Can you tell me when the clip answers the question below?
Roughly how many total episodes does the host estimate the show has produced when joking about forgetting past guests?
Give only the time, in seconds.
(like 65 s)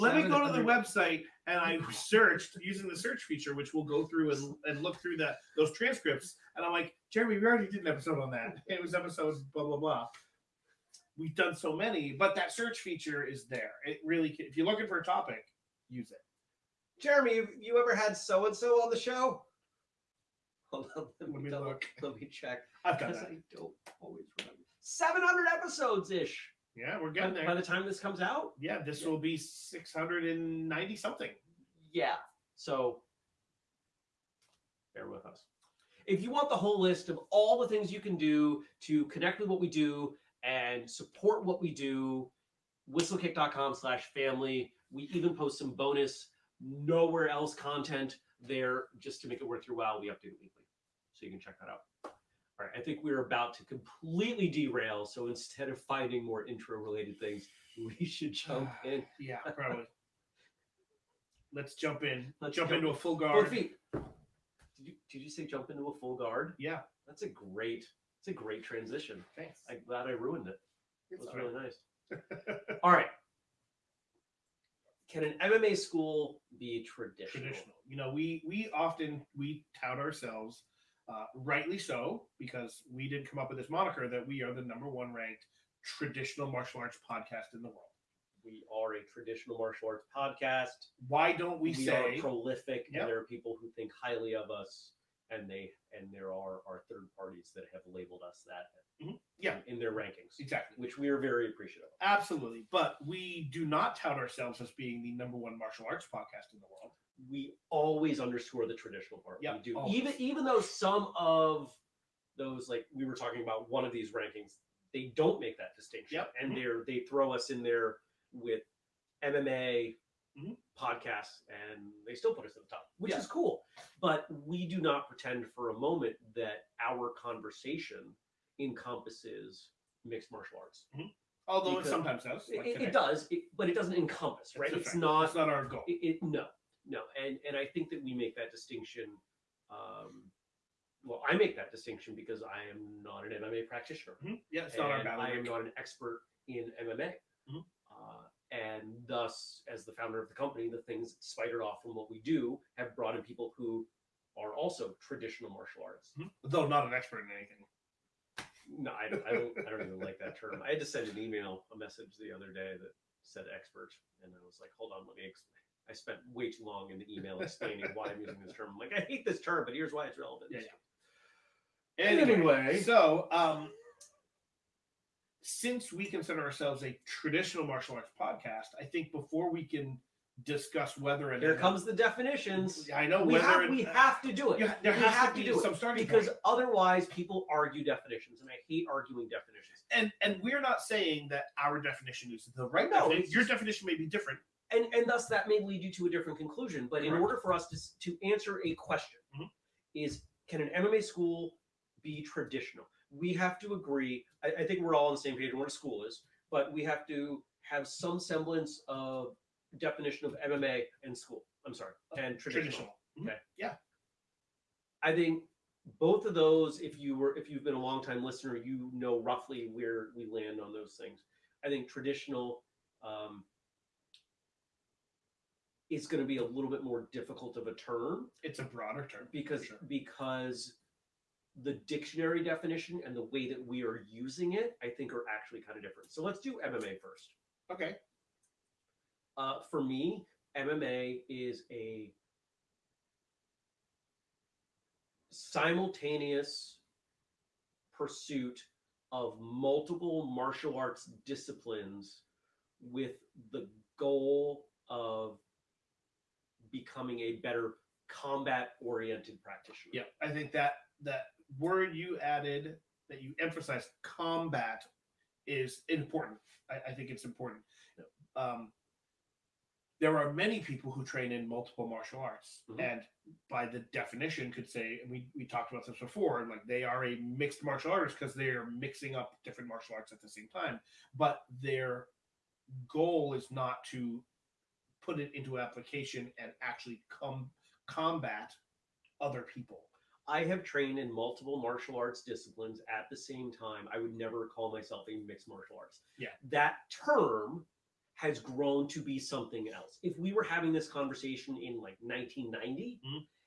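24 s.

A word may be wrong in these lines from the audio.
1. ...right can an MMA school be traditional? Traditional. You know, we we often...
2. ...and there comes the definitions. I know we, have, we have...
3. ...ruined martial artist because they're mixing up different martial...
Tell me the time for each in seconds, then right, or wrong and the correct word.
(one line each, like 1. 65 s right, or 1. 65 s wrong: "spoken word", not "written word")
1. 72 s right
2. 181 s right
3. 277 s wrong: "mixed", not "ruined".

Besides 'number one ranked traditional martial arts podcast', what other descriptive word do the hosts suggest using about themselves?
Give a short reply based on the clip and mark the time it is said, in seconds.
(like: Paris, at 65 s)
prolific, at 92 s.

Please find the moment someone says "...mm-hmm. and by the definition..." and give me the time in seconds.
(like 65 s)
272 s.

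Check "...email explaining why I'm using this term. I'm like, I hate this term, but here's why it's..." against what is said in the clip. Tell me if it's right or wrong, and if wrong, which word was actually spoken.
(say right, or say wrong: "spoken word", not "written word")
right.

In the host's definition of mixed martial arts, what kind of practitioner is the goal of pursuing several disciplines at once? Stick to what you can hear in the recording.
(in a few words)
combat oriented.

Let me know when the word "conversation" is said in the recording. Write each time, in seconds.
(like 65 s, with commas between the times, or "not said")
127 s, 300 s.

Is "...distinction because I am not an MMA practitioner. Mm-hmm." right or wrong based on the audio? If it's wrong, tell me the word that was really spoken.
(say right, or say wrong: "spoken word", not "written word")
right.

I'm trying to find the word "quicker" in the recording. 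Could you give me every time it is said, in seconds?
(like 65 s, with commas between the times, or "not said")
not said.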